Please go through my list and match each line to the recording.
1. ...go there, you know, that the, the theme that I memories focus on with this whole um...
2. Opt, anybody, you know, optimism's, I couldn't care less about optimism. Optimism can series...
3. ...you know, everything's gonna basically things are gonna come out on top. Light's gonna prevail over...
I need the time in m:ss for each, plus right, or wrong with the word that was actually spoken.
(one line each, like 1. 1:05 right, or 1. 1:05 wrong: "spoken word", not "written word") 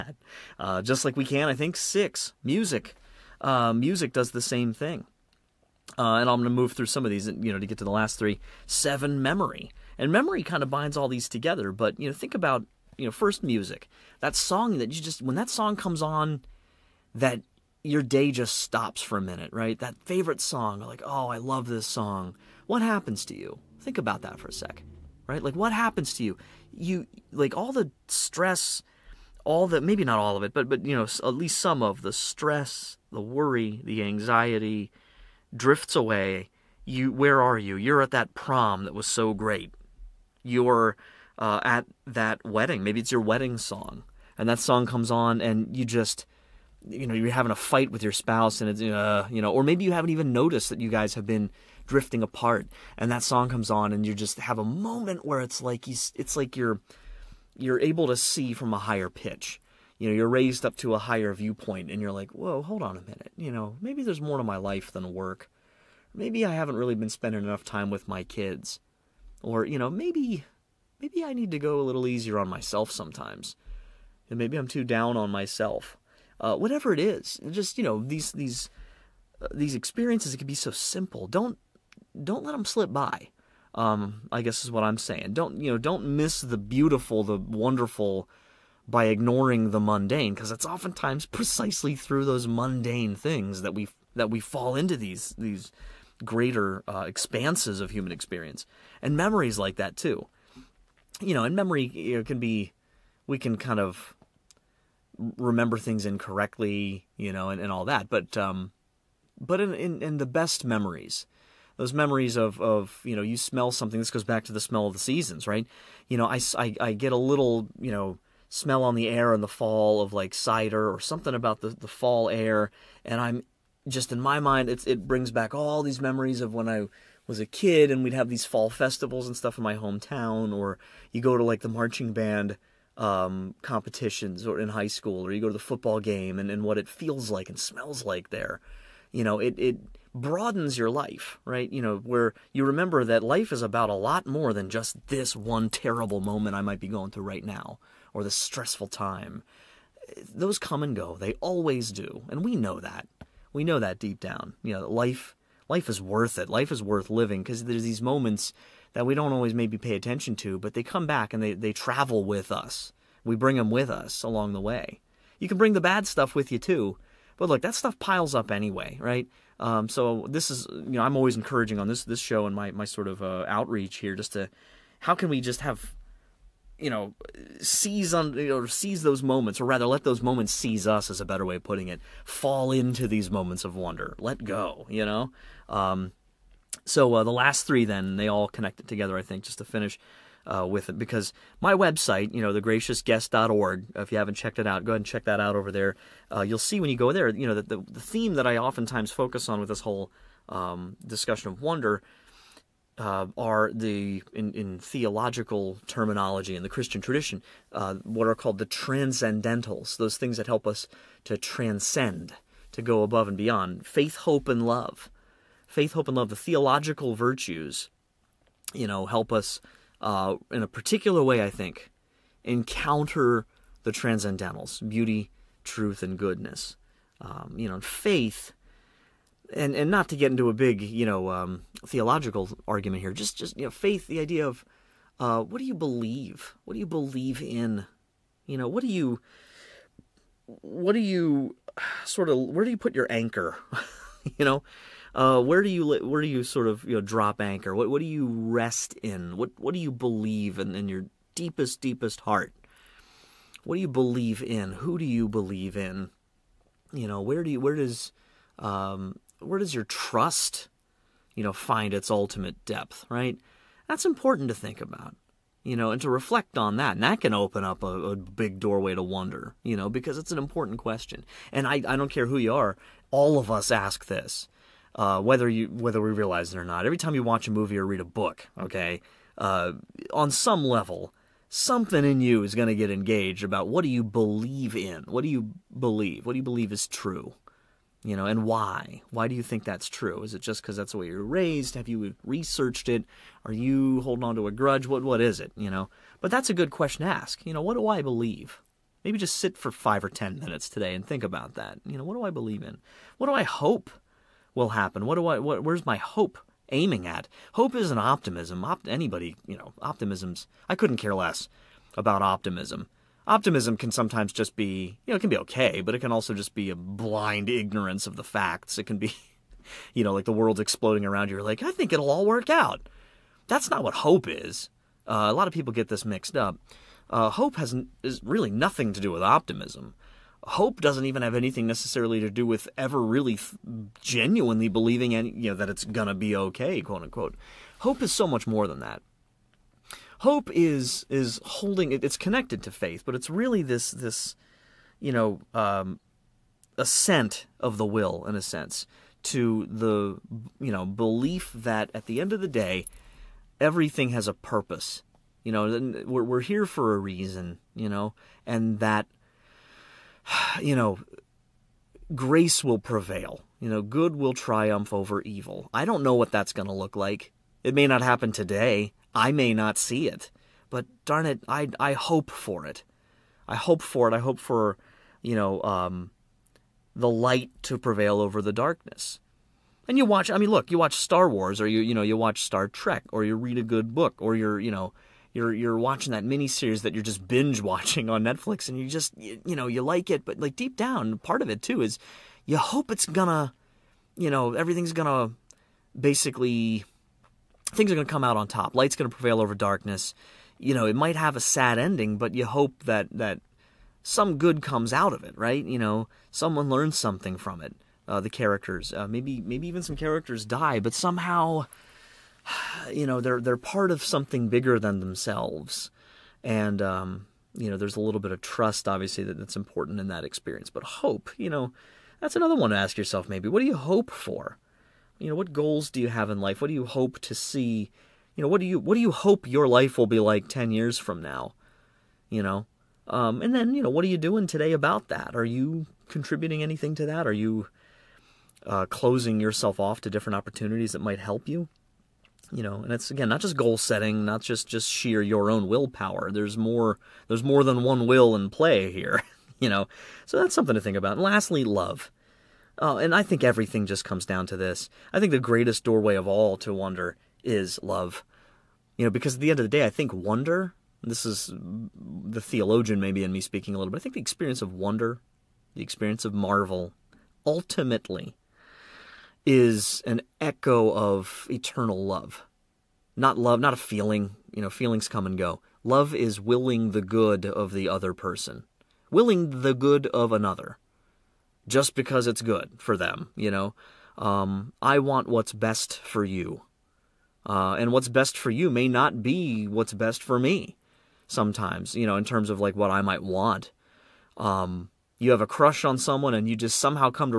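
1. 3:16 wrong: "oftentimes", not "memories"
2. 5:08 wrong: "sometimes", not "series"
3. 6:34 right.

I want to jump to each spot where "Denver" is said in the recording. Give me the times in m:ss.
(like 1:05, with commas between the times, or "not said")
not said.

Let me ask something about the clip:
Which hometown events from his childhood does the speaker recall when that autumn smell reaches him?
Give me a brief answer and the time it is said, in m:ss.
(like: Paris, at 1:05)
fall festivals, at 2:08.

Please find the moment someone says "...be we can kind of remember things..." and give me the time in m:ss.
1:42.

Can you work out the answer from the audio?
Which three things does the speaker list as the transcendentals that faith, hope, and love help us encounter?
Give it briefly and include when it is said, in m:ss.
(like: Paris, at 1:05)
beauty, truth, and goodness, at 3:44.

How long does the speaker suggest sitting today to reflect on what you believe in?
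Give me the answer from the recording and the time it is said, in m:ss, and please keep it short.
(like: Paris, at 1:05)
5 or 10 minutes, at 4:59.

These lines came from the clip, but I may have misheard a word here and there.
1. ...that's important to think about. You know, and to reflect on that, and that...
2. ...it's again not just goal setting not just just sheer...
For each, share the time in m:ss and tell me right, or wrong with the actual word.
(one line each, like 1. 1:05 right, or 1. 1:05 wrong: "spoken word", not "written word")
1. 4:23 right
2. 7:22 right.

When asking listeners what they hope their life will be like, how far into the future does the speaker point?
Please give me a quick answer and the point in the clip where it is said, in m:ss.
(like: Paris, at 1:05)
10 years, at 7:10.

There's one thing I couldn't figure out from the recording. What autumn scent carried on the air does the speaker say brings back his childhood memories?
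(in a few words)
cider.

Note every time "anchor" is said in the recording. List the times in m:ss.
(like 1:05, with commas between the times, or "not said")
4:03, 4:07.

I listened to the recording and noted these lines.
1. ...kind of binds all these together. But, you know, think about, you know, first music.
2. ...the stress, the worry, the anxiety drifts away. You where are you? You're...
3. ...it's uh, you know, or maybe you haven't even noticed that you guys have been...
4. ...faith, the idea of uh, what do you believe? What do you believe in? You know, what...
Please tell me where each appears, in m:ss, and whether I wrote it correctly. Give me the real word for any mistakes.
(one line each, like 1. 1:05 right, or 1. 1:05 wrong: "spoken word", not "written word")
1. 0:10 right
2. 0:32 right
3. 0:48 right
4. 3:53 right.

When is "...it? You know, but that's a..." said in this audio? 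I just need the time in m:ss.
4:55.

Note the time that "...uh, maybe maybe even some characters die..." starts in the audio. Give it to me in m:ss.
6:48.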